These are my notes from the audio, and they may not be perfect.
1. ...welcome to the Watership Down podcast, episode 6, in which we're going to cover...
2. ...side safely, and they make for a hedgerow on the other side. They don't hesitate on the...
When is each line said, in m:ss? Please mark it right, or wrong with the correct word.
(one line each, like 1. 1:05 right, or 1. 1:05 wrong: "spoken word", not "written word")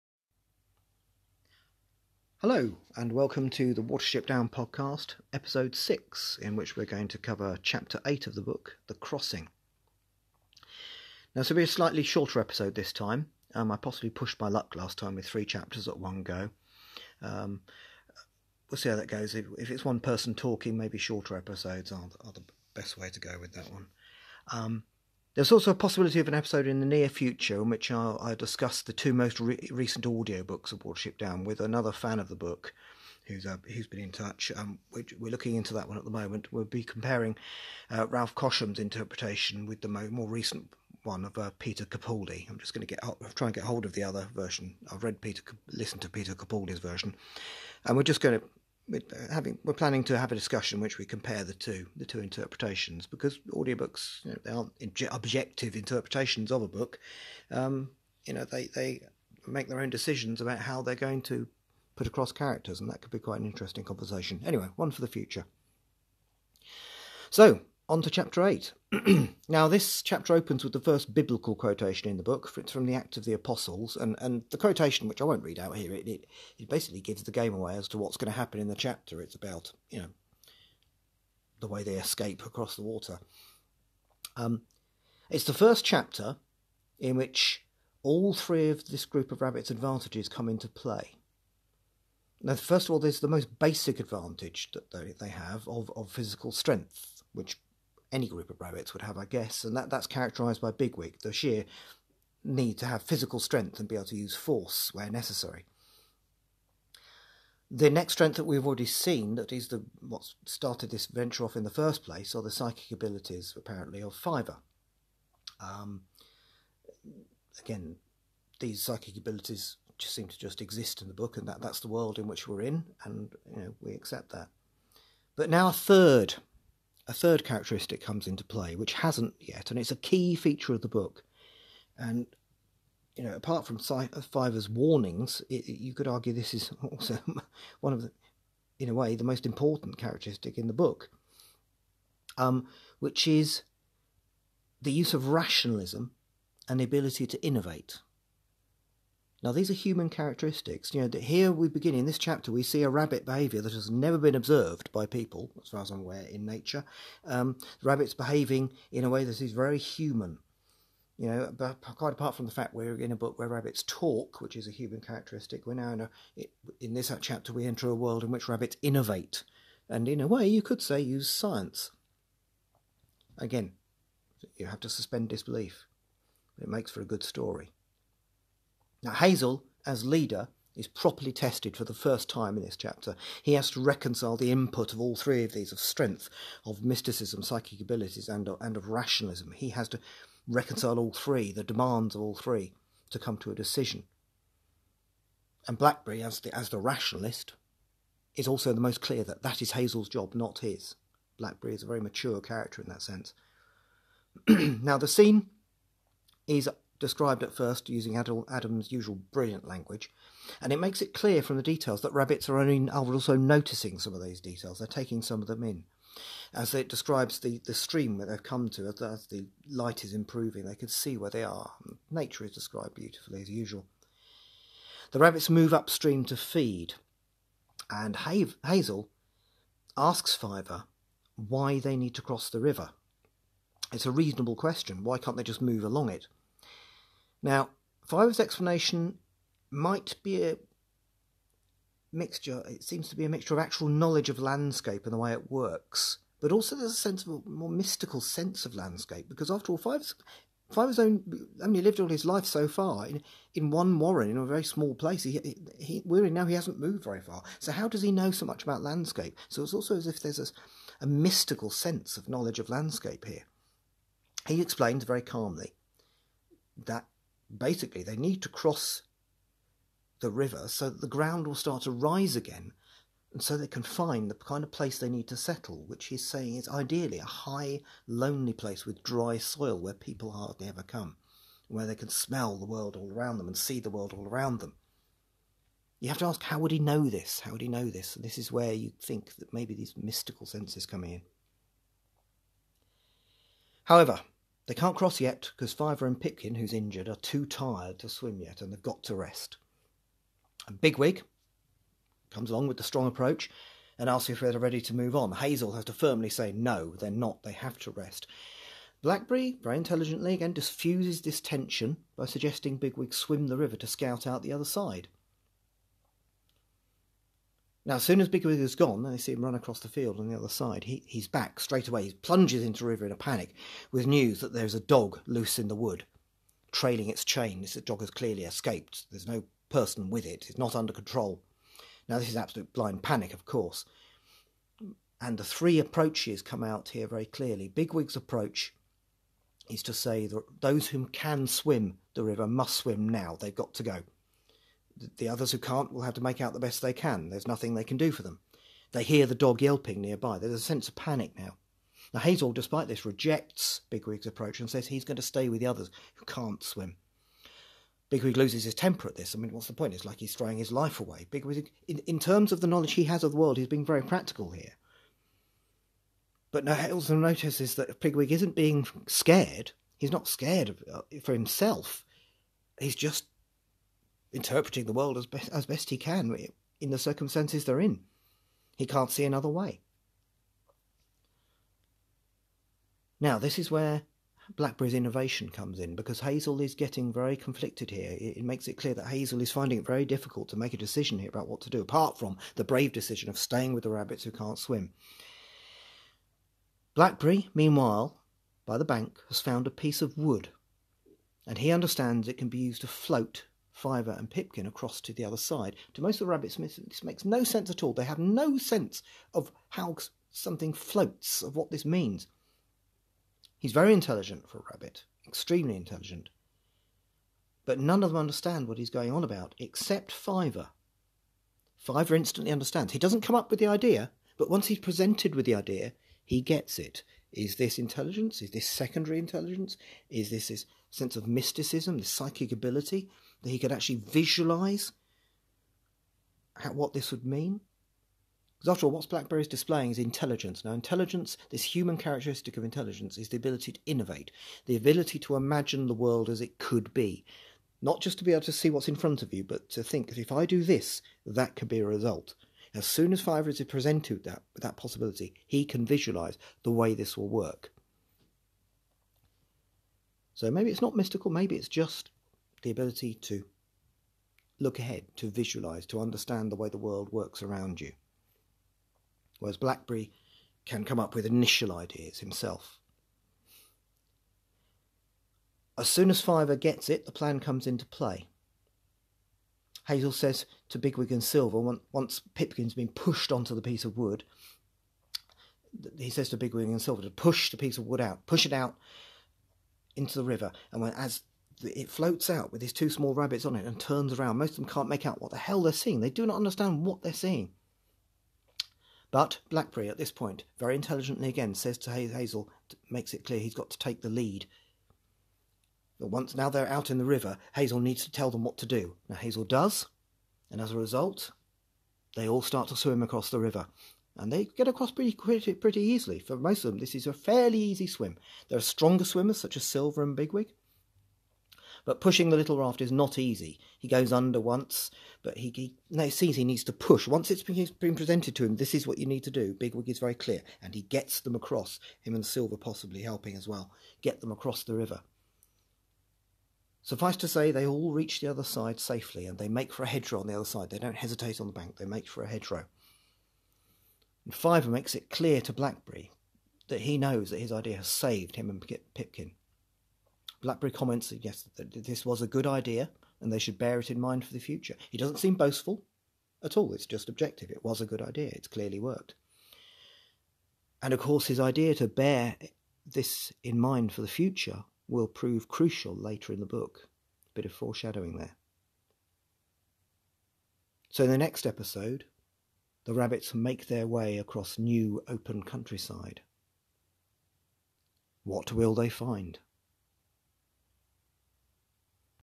1. 0:03 right
2. 8:58 right.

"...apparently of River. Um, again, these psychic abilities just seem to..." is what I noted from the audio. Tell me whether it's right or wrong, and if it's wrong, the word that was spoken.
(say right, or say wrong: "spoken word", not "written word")
wrong: "Fiver", not "River".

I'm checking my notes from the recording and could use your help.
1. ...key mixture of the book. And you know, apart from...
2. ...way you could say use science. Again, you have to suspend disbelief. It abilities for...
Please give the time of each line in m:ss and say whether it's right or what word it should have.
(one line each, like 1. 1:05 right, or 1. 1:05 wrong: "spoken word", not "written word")
1. 2:09 wrong: "feature", not "mixture"
2. 2:50 wrong: "makes", not "abilities".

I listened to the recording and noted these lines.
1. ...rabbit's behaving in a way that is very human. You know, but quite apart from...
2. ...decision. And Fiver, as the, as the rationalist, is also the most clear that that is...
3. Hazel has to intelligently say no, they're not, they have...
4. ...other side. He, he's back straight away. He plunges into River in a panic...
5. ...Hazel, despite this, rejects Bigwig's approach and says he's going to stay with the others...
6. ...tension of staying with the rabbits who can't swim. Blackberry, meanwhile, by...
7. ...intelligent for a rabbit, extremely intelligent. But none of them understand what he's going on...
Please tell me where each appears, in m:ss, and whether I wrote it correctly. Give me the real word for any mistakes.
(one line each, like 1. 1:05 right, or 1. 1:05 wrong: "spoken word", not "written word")
1. 2:37 right
2. 3:13 wrong: "Blackberry", not "Fiver"
3. 5:05 wrong: "firmly", not "intelligently"
4. 5:20 right
5. 5:52 right
6. 6:32 wrong: "decision", not "tension"
7. 6:53 right.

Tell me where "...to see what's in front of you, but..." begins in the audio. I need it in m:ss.
7:28.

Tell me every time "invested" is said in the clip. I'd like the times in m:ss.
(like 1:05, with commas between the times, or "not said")
not said.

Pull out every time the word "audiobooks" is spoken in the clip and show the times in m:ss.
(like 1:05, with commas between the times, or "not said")
0:30, 0:53.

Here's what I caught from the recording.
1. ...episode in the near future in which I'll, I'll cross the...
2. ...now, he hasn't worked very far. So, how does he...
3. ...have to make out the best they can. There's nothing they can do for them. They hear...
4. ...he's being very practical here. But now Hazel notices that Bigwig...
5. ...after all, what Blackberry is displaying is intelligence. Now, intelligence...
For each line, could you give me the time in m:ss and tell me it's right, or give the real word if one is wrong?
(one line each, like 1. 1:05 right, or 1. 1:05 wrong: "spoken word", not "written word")
1. 0:26 wrong: "discuss", not "cross"
2. 4:16 wrong: "moved", not "worked"
3. 5:46 right
4. 6:03 right
5. 7:18 right.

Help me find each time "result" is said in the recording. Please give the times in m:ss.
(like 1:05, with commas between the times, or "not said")
7:31, 8:30.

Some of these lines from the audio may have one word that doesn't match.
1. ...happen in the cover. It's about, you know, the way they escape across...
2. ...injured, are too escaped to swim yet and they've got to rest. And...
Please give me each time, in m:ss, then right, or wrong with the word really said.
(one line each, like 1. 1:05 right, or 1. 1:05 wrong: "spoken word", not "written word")
1. 1:18 wrong: "chapter", not "cover"
2. 4:56 wrong: "tired", not "escaped".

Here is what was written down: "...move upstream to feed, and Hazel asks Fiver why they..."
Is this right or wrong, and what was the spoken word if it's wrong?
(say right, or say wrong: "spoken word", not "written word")
right.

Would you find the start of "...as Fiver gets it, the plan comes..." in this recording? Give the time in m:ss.
7:56.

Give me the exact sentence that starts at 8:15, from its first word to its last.
They do not understand what they're seeing.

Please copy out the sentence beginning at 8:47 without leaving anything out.
Once it's been, been presented to him, this is what you need to do.